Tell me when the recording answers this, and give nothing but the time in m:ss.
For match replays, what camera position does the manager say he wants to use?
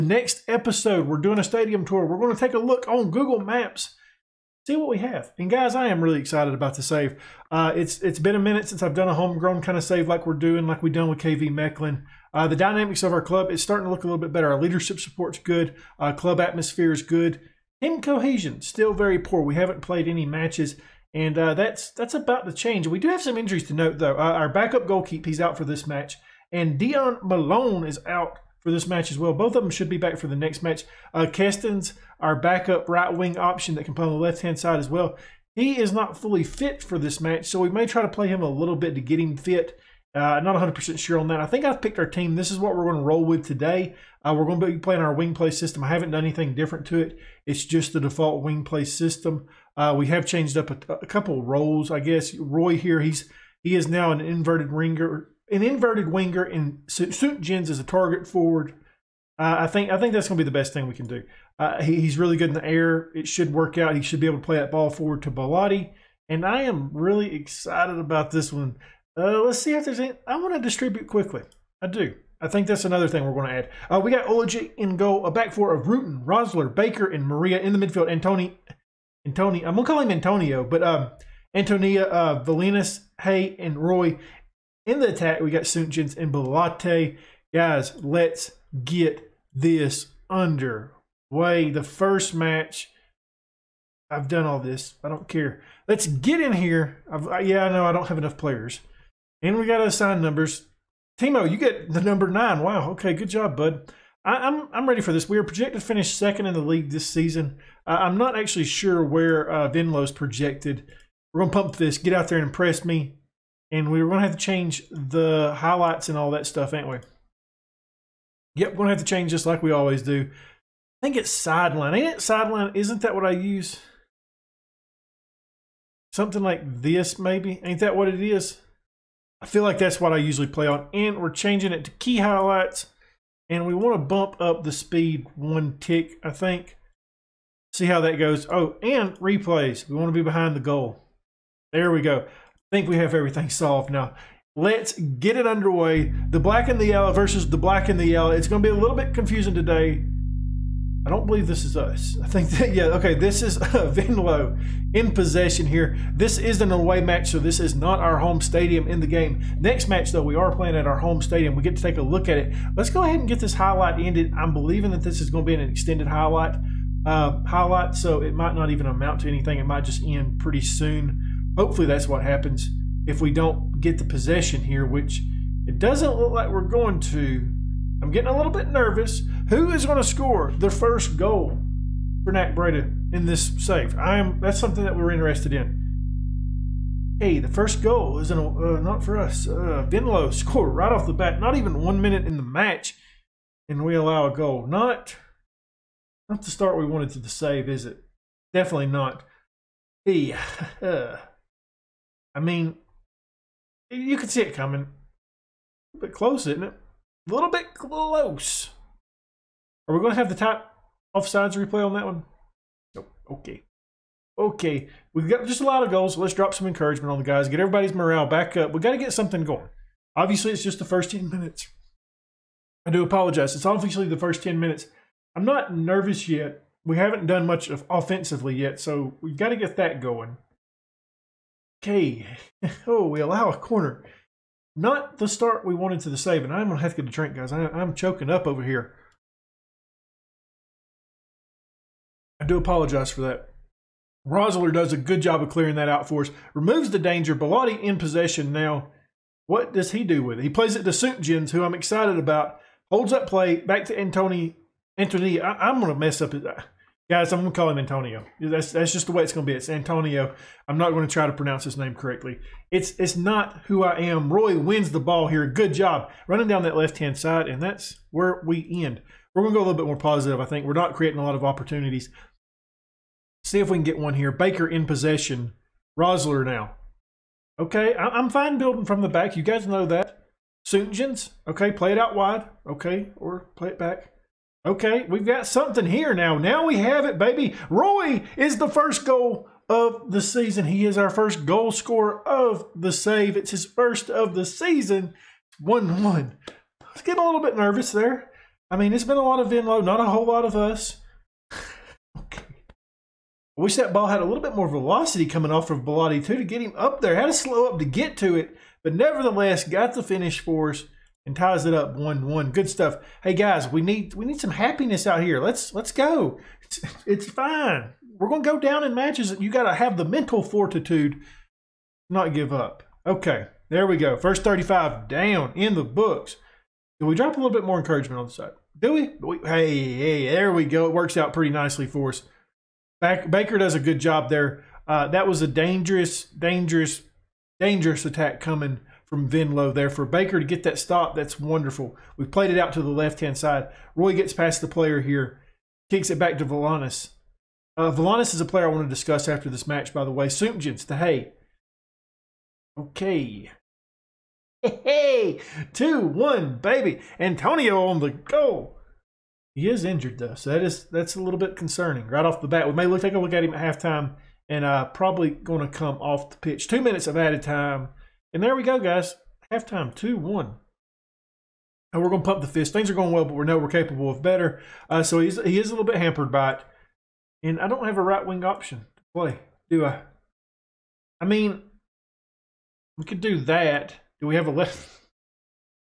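2:20.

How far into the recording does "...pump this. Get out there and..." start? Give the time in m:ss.
1:51.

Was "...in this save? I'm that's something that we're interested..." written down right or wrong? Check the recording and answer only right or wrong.
right.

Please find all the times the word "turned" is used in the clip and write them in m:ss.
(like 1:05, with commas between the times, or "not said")
not said.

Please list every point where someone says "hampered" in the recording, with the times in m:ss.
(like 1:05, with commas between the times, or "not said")
6:15.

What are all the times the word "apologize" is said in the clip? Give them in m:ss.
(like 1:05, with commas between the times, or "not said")
3:43, 4:02.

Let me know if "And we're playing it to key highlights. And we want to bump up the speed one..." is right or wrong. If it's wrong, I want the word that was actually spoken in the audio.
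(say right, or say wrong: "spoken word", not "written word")
wrong: "changing", not "playing".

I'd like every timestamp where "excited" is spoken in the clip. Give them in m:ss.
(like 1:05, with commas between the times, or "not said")
0:06, 1:07, 4:11.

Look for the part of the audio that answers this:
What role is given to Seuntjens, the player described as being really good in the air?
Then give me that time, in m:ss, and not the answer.
0:57.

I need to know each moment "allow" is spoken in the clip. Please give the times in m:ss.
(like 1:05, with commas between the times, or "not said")
3:13, 3:53.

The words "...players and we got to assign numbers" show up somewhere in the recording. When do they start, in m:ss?
1:38.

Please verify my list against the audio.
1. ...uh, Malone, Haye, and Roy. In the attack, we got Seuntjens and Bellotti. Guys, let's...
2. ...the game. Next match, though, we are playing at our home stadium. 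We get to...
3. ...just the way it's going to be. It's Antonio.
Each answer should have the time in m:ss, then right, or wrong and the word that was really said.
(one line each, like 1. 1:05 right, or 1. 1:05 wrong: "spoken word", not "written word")
1. 1:22 wrong: "Valinas", not "Malone"
2. 2:39 right
3. 4:18 right.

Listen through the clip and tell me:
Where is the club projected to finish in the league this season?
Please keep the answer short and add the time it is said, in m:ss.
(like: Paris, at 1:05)
Second, at 1:46.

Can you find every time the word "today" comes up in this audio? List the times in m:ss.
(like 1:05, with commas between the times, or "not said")
0:43, 2:29.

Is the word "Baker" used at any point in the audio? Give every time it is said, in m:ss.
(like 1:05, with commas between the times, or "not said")
1:16, 4:34, 5:33, 5:40.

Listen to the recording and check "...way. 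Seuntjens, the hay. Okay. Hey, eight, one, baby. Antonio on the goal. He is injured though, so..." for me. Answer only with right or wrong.
wrong.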